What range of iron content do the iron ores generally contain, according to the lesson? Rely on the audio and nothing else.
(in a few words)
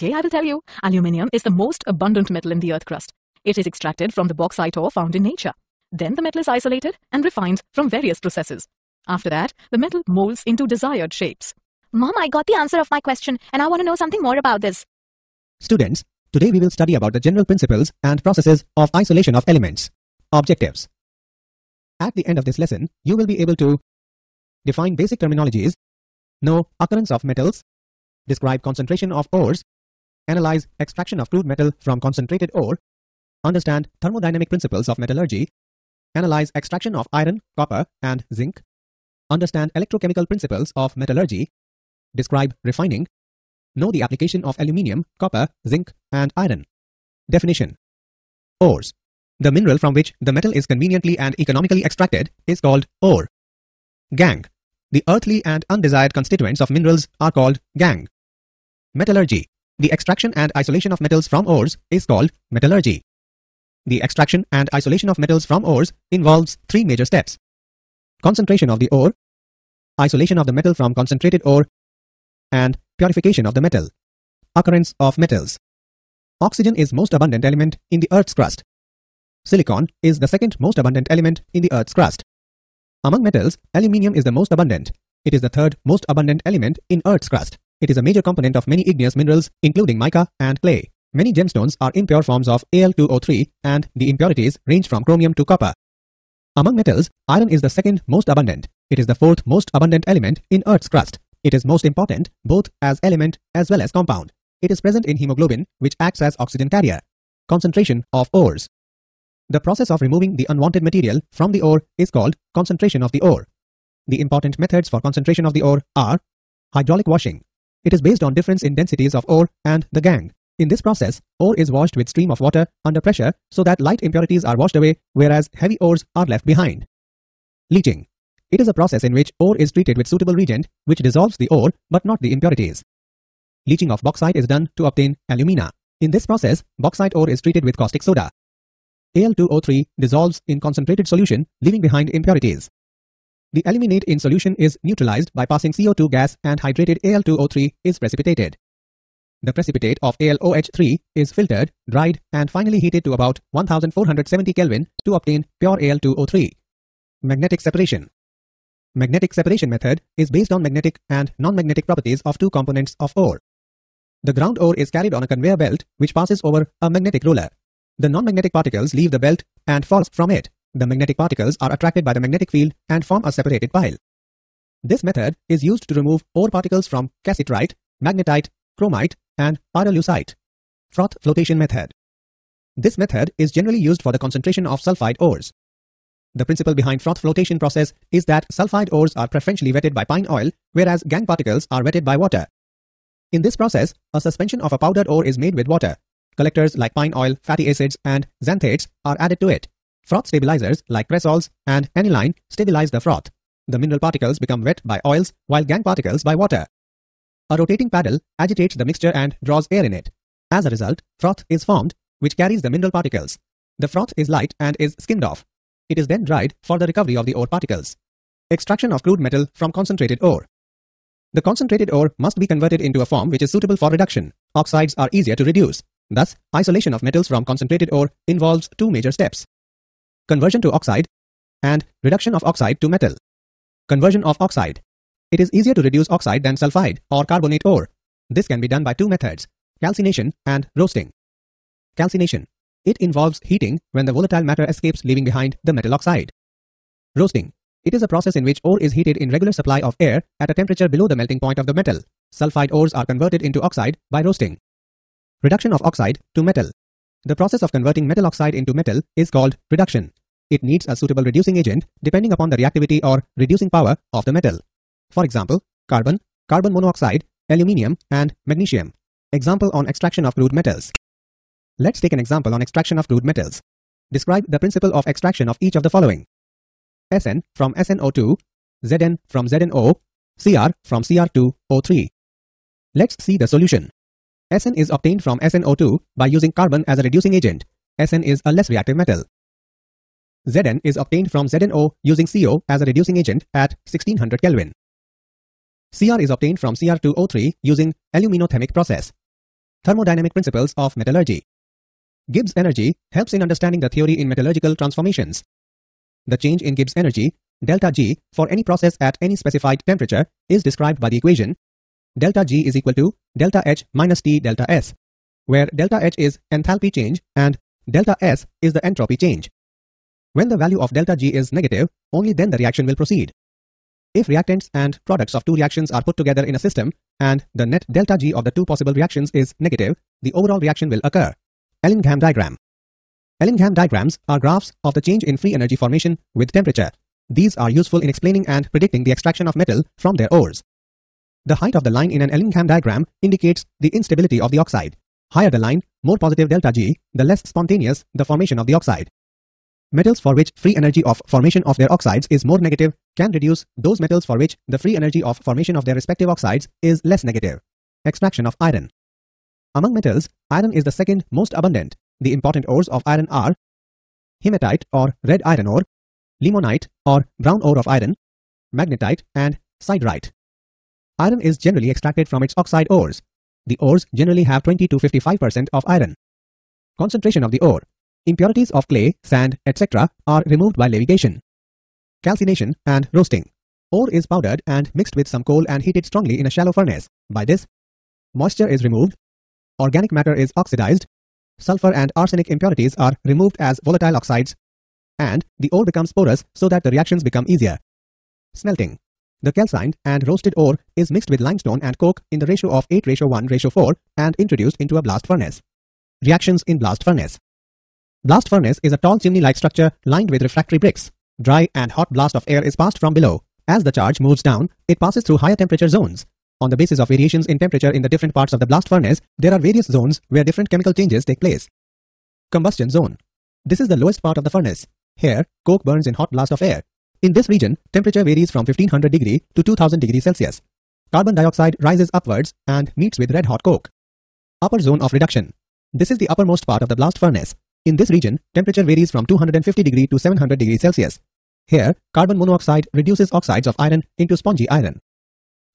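20 to 55%.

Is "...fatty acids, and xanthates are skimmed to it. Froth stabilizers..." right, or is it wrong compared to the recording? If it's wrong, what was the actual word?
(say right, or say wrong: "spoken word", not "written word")
wrong: "added", not "skimmed".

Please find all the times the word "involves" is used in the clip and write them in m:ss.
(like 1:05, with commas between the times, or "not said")
1:06, 3:48, 4:03.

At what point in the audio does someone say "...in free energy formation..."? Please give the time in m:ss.
5:35.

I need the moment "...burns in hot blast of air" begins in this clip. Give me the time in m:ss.
7:05.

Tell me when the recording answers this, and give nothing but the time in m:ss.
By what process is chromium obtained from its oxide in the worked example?
4:58.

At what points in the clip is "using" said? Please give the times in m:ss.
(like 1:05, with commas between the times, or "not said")
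4:46, 4:52, 4:57.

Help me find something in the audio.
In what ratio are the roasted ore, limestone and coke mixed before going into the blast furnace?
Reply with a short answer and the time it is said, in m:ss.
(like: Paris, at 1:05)
8:1:4, at 6:42.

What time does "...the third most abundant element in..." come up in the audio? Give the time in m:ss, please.
1:25.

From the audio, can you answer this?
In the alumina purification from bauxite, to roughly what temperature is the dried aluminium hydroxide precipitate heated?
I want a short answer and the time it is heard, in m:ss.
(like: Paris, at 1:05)
1470 Kelvin, at 2:33.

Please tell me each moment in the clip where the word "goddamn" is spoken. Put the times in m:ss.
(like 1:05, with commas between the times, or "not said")
not said.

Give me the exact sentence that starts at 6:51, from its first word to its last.
Dry and hot blast of air is passed from below.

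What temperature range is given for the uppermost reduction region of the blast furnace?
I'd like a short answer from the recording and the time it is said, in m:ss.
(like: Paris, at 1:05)
250 to 700 degrees Celsius, at 7:19.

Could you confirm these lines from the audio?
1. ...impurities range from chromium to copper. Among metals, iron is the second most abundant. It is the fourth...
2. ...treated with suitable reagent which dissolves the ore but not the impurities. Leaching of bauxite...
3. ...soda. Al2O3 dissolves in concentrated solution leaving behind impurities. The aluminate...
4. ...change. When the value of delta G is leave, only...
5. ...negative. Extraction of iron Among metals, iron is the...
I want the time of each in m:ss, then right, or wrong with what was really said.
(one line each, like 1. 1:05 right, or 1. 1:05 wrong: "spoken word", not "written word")
1. 1:34 right
2. 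2:09 right
3. 2:18 right
4. 5:19 wrong: "negative", not "leave"
5. 5:57 right.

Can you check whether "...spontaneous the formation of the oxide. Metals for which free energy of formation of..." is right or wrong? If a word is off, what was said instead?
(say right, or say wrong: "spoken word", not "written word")
right.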